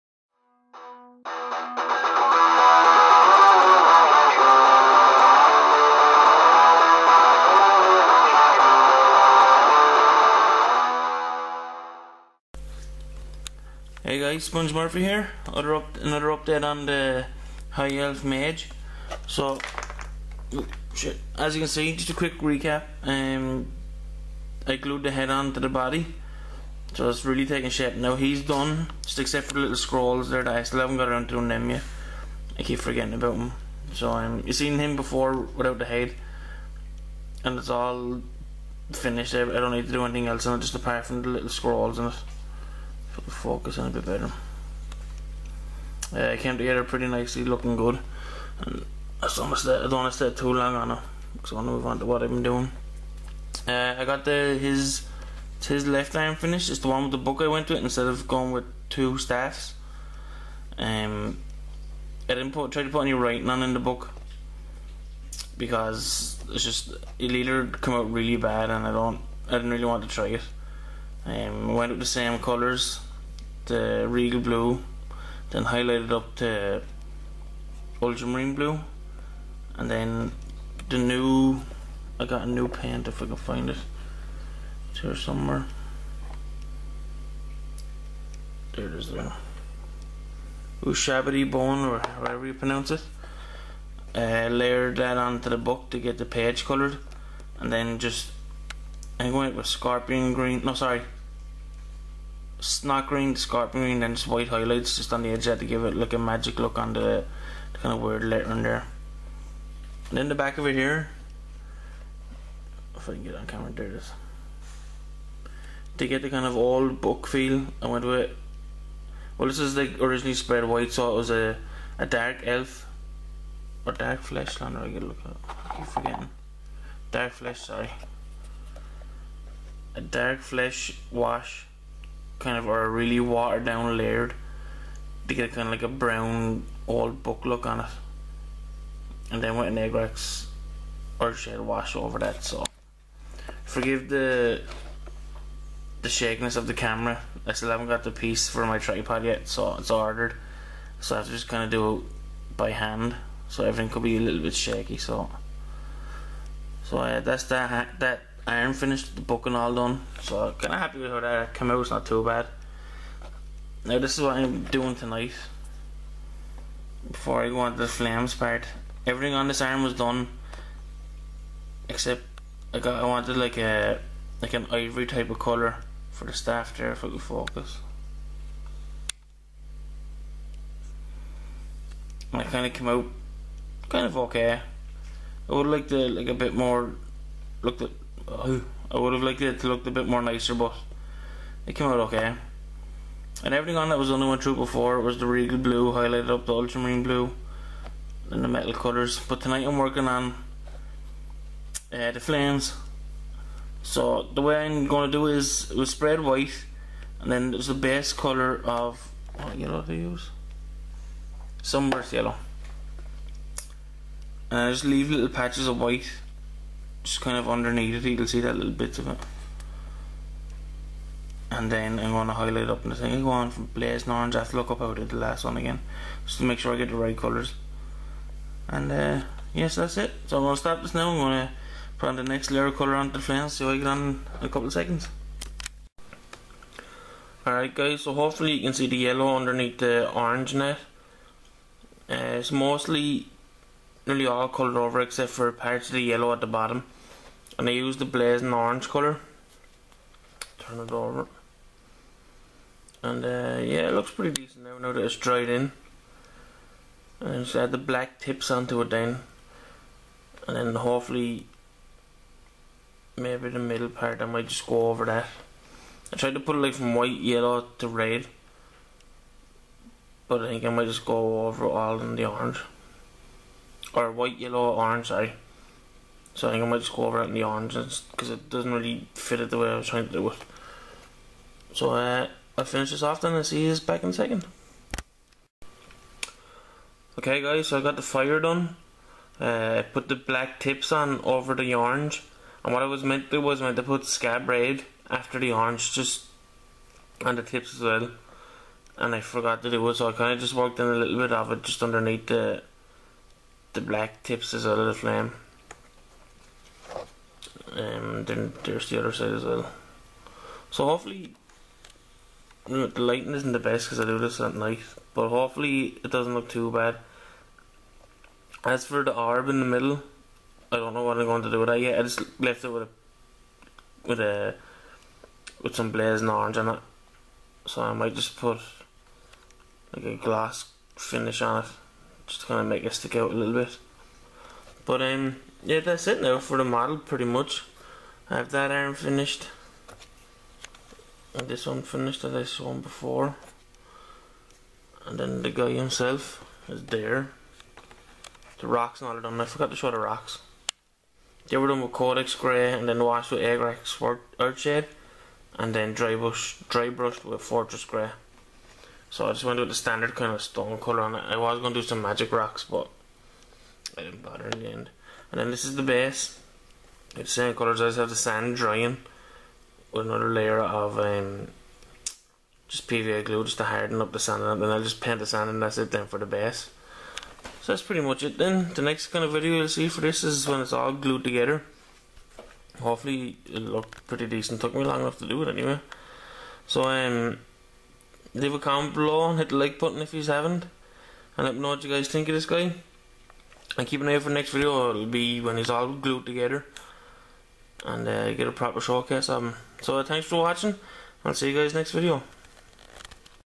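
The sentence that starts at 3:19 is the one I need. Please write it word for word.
But tonight I'm working on uh, the flames.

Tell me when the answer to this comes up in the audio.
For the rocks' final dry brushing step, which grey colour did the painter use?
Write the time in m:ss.
5:57.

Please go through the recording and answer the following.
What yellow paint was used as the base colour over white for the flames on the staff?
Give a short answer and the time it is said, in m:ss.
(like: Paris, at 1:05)
Sunburst Yellow, at 3:31.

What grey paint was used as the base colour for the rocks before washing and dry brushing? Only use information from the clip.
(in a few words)
Codex Grey.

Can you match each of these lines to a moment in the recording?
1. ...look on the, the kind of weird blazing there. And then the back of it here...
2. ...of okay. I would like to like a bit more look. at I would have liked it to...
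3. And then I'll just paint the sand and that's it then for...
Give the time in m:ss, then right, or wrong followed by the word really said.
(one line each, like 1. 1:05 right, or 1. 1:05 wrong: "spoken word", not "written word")
1. 1:46 wrong: "lettering", not "blazing"
2. 3:04 right
3. 6:14 right.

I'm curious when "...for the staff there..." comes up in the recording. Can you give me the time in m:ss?
2:56.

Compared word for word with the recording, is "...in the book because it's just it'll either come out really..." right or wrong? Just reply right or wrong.
right.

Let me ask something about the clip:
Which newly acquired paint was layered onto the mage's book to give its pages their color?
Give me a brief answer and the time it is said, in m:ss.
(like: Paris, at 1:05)
Ushabti Bone, at 1:30.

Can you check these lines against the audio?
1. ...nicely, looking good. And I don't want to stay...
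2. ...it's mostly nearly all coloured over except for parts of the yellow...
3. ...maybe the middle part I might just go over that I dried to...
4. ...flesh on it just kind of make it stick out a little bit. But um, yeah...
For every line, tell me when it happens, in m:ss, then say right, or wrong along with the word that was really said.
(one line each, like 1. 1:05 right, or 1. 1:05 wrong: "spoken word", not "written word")
1. 0:47 right
2. 4:02 right
3. 4:23 wrong: "tried", not "dried"
4. 5:30 wrong: "finish", not "flesh".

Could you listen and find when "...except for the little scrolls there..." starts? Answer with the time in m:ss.
0:29.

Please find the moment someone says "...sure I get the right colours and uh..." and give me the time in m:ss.
3:46.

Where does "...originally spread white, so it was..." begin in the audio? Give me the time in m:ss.
1:59.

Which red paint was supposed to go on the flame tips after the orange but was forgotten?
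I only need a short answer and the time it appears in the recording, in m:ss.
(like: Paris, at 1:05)
Scab Red, at 4:54.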